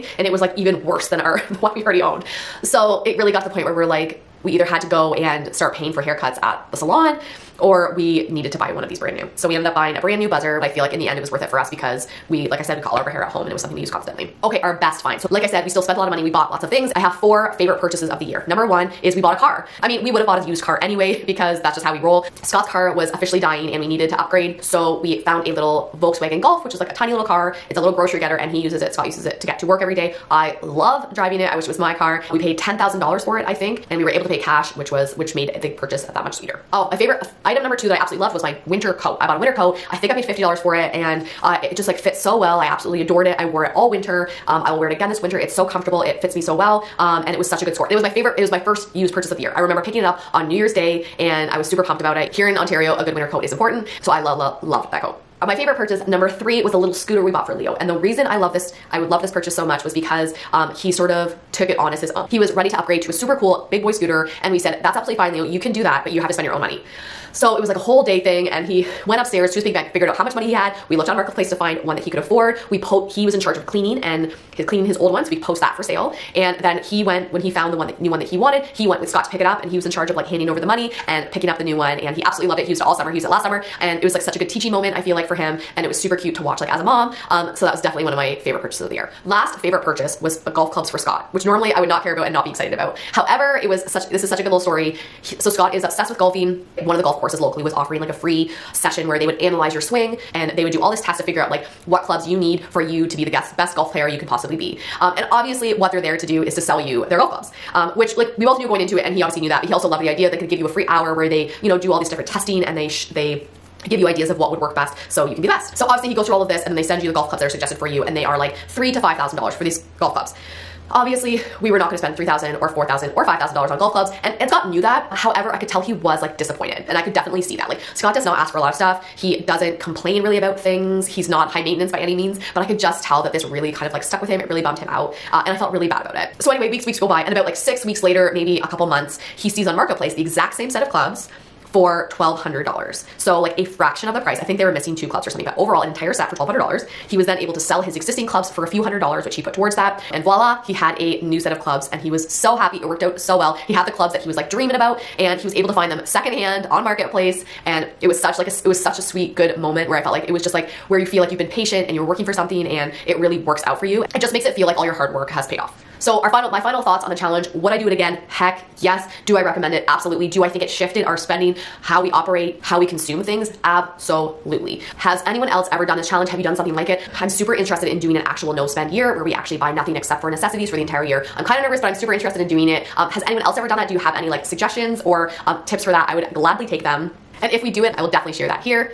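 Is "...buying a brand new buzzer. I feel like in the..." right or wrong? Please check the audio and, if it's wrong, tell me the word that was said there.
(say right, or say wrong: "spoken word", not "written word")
right.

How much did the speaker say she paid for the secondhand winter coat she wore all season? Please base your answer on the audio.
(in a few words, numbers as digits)
$50.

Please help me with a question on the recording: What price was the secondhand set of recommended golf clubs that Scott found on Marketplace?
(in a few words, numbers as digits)
$1,200.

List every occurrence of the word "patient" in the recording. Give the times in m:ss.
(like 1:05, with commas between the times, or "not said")
2:41.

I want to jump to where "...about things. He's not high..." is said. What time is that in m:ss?
2:10.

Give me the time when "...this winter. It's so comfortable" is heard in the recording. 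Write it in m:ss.
0:45.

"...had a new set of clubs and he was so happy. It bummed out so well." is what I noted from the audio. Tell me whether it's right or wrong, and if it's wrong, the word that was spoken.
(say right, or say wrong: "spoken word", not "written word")
wrong: "worked", not "bummed".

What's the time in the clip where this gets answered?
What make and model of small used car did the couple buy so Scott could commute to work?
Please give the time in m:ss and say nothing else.
0:26.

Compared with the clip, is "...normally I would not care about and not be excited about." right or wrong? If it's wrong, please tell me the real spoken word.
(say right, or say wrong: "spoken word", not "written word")
right.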